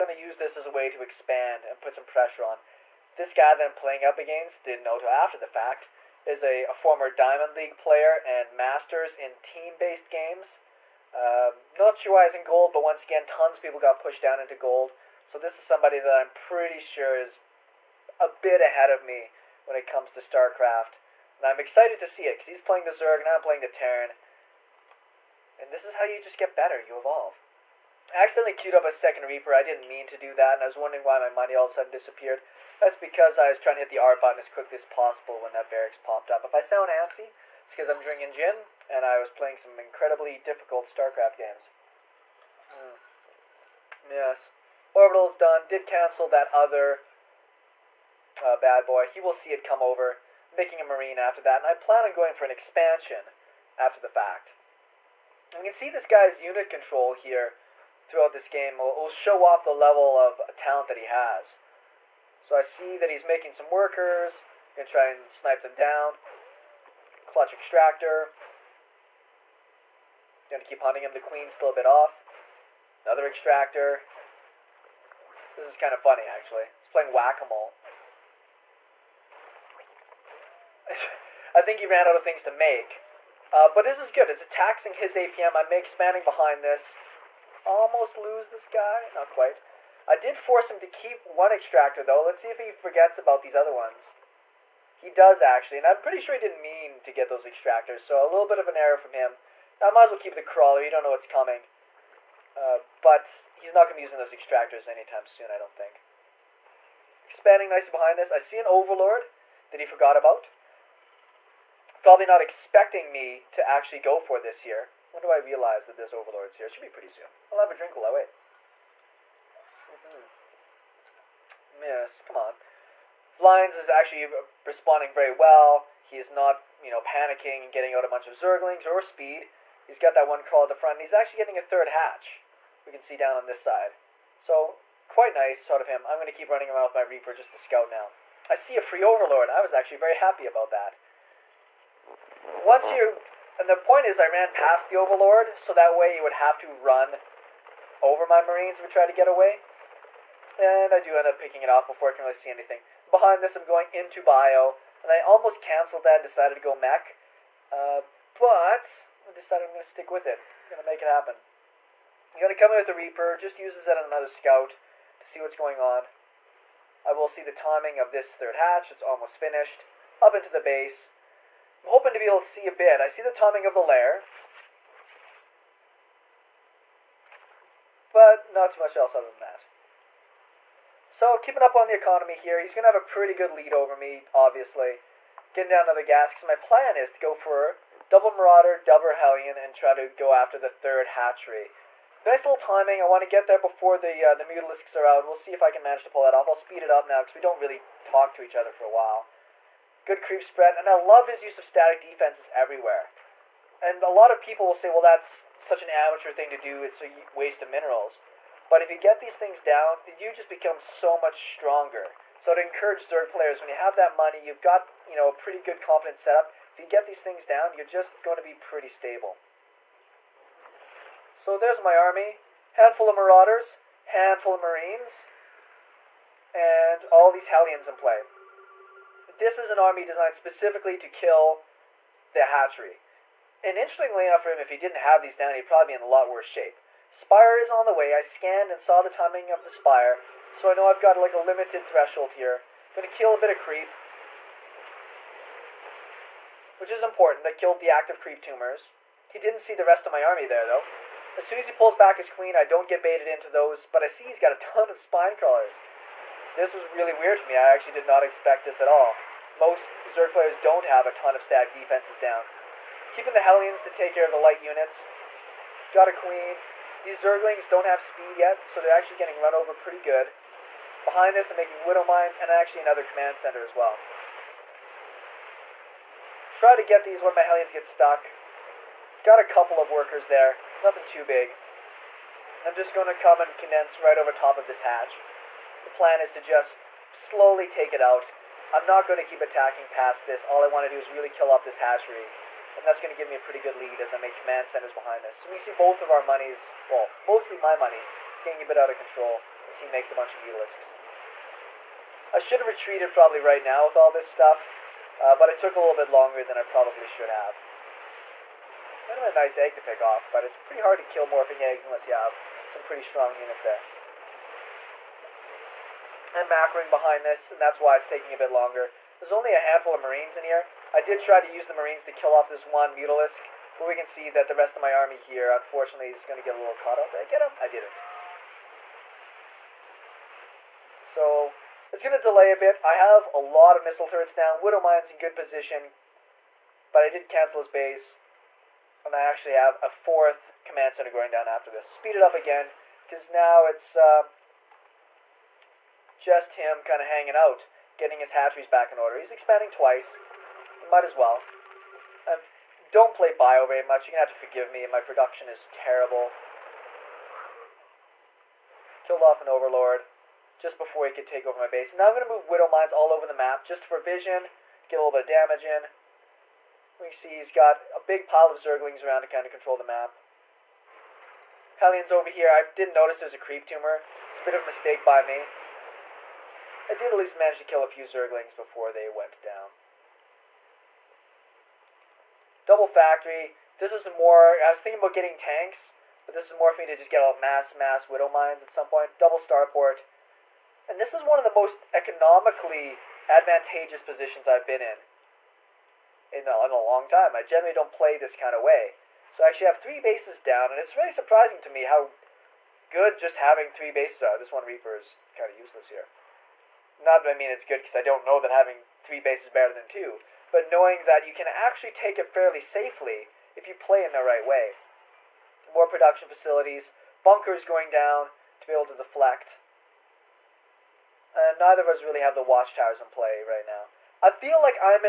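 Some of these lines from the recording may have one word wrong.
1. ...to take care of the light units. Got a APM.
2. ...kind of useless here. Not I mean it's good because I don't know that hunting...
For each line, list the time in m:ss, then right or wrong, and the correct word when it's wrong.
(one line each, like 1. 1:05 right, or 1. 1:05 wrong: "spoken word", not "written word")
1. 4:23 wrong: "Queen", not "APM"
2. 6:45 wrong: "having", not "hunting".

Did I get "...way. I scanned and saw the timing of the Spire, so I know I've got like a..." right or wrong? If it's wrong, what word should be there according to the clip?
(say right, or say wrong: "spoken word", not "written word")
right.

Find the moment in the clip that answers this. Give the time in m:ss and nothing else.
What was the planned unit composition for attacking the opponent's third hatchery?
3:08.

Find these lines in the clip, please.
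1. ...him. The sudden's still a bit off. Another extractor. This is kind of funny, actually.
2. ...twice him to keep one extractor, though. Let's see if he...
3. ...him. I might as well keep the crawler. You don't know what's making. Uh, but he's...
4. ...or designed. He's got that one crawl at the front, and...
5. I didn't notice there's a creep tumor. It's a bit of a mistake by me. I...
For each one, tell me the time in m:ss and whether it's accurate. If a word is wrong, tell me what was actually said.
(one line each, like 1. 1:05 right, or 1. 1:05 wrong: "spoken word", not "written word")
1. 1:11 wrong: "queen", not "sudden"
2. 1:30 wrong: "force", not "twice"
3. 1:39 wrong: "coming", not "making"
4. 2:08 wrong: "speed", not "designed"
5. 6:12 right.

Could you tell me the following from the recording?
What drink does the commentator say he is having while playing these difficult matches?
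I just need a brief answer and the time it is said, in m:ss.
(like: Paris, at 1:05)
gin, at 0:38.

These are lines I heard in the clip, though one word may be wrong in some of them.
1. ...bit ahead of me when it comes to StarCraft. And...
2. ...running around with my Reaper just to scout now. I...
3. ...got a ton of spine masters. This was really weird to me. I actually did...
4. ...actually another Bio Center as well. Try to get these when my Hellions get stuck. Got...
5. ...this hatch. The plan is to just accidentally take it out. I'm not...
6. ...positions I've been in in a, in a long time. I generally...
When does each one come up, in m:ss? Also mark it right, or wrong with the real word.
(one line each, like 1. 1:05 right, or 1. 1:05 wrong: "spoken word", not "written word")
1. 0:18 right
2. 2:16 right
3. 4:14 wrong: "crawlers", not "masters"
4. 4:32 wrong: "Command", not "Bio"
5. 4:44 wrong: "slowly", not "accidentally"
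6. 6:34 right.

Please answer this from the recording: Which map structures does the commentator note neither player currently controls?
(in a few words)
watchtowers.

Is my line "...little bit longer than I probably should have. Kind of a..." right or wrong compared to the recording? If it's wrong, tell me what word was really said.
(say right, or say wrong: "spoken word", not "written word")
right.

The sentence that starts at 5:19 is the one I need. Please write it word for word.
There's only a handful of marines in here.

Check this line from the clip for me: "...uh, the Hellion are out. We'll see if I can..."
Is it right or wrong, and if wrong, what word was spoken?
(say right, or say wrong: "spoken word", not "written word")
wrong: "Mutalisks", not "Hellion".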